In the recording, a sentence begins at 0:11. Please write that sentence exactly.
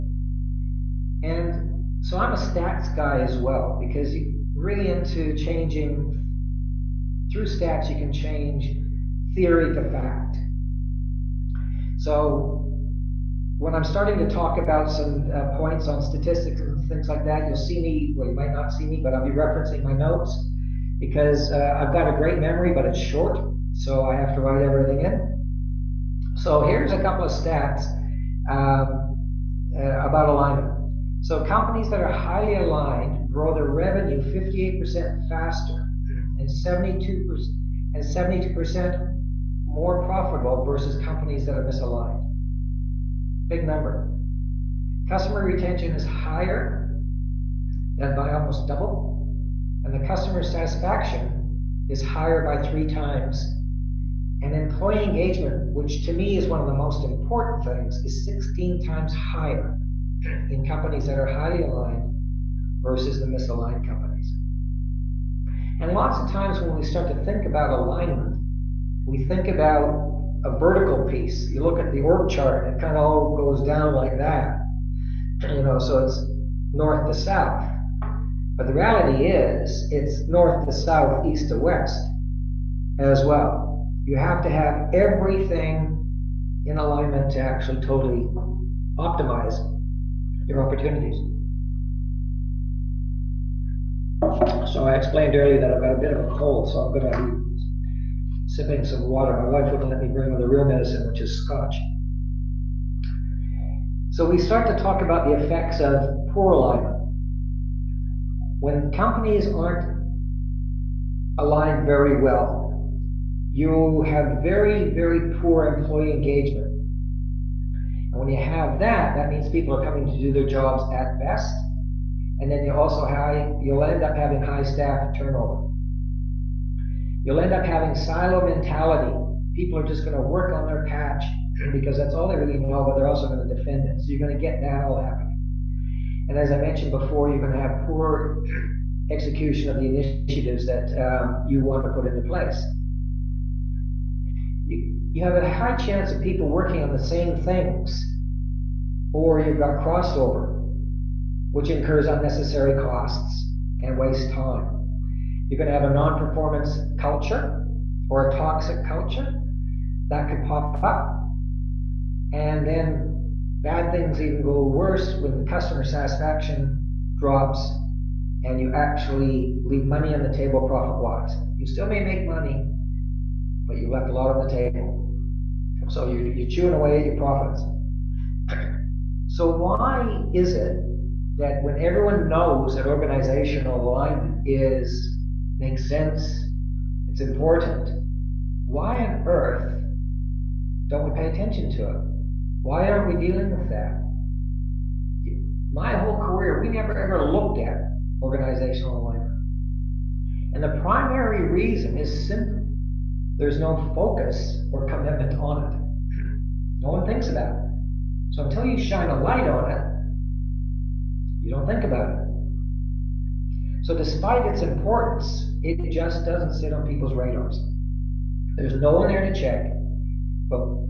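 So when I'm starting to talk about some uh, points on statistics and things like that, you'll see me.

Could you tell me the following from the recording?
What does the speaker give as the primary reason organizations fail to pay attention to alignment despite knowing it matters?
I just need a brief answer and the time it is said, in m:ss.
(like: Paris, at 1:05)
no focus or commitment, at 3:23.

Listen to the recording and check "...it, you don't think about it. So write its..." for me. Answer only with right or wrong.
wrong.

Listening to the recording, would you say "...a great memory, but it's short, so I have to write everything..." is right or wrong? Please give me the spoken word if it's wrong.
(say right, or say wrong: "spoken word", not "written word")
right.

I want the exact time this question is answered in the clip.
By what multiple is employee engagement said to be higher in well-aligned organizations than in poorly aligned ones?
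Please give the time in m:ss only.
0:58.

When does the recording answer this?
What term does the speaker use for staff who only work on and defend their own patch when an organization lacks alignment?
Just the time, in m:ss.
2:07.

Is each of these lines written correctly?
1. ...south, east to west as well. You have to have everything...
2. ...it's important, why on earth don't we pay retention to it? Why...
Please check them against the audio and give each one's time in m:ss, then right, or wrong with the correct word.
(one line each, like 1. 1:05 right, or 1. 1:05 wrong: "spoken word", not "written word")
1. 1:20 right
2. 3:07 wrong: "attention", not "retention".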